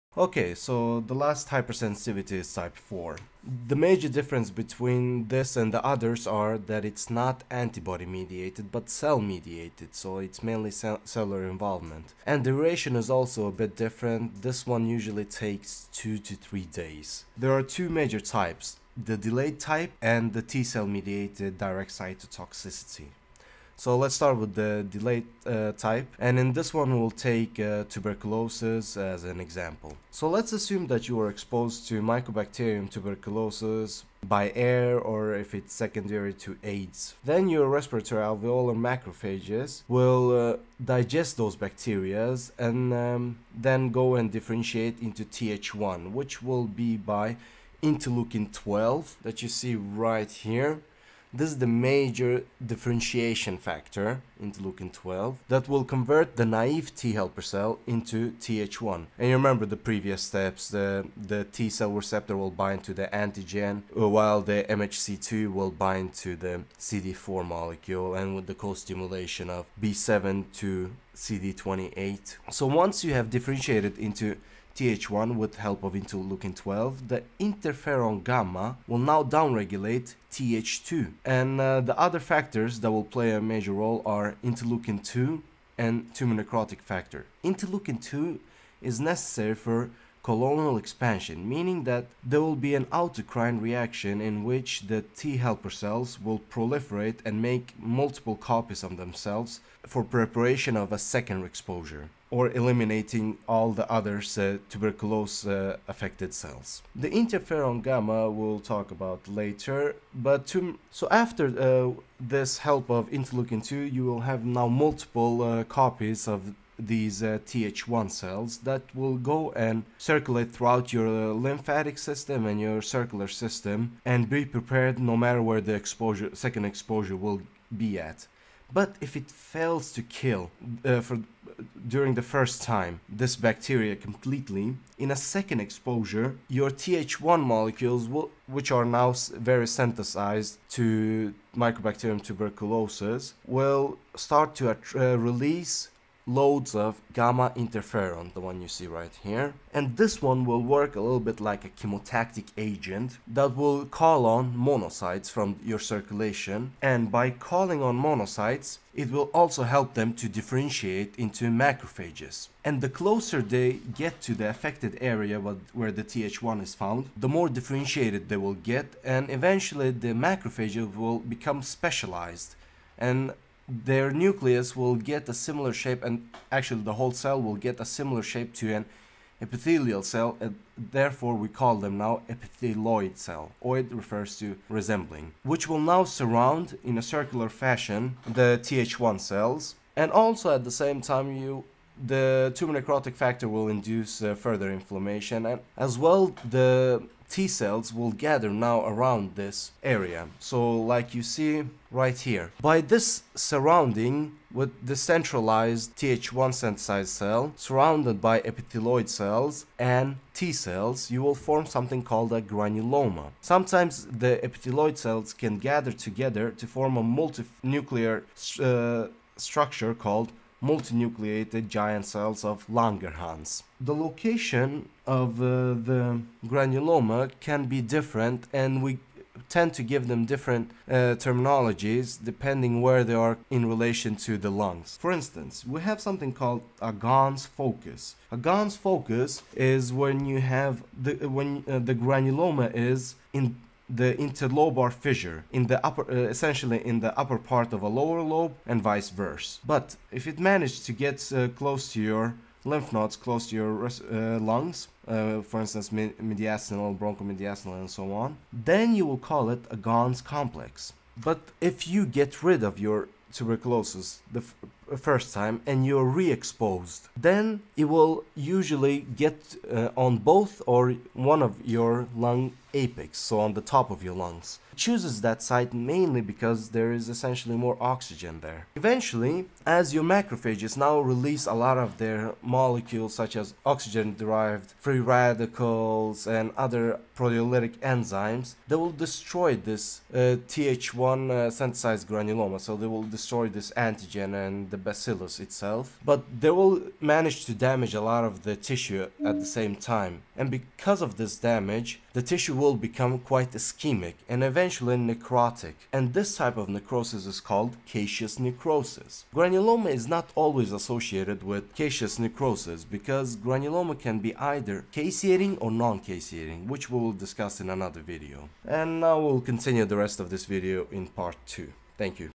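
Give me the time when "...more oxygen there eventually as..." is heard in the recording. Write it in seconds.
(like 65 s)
277 s.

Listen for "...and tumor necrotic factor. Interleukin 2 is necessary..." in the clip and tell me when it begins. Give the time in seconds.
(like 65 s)
85 s.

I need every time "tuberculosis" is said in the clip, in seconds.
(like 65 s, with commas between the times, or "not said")
27 s, 32 s, 142 s, 263 s.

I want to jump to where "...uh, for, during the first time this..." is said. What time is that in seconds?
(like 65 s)
130 s.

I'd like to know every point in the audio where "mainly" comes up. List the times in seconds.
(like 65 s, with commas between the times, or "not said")
10 s, 275 s.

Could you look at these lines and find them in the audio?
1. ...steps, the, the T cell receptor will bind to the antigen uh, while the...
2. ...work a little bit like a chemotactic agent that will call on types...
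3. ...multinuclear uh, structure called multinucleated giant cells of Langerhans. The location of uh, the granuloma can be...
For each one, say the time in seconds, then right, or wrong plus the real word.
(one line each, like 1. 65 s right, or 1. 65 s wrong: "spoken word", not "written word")
1. 60 s right
2. 150 s wrong: "monocytes", not "types"
3. 217 s right.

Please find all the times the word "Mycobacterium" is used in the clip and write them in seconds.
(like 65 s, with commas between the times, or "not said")
32 s, 141 s.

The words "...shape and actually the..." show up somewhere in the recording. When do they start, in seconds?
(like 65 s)
175 s.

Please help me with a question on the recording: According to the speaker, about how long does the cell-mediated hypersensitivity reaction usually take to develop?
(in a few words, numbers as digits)
2 to 3 days.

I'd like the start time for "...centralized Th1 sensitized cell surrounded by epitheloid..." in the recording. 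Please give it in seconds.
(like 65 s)
204 s.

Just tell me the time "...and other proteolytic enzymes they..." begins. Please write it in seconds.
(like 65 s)
286 s.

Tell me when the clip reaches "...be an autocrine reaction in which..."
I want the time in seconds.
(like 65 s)
92 s.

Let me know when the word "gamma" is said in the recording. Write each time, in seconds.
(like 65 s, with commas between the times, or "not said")
78 s, 107 s, 147 s.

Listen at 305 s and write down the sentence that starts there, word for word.
And this type of necrosis is called caseous necrosis.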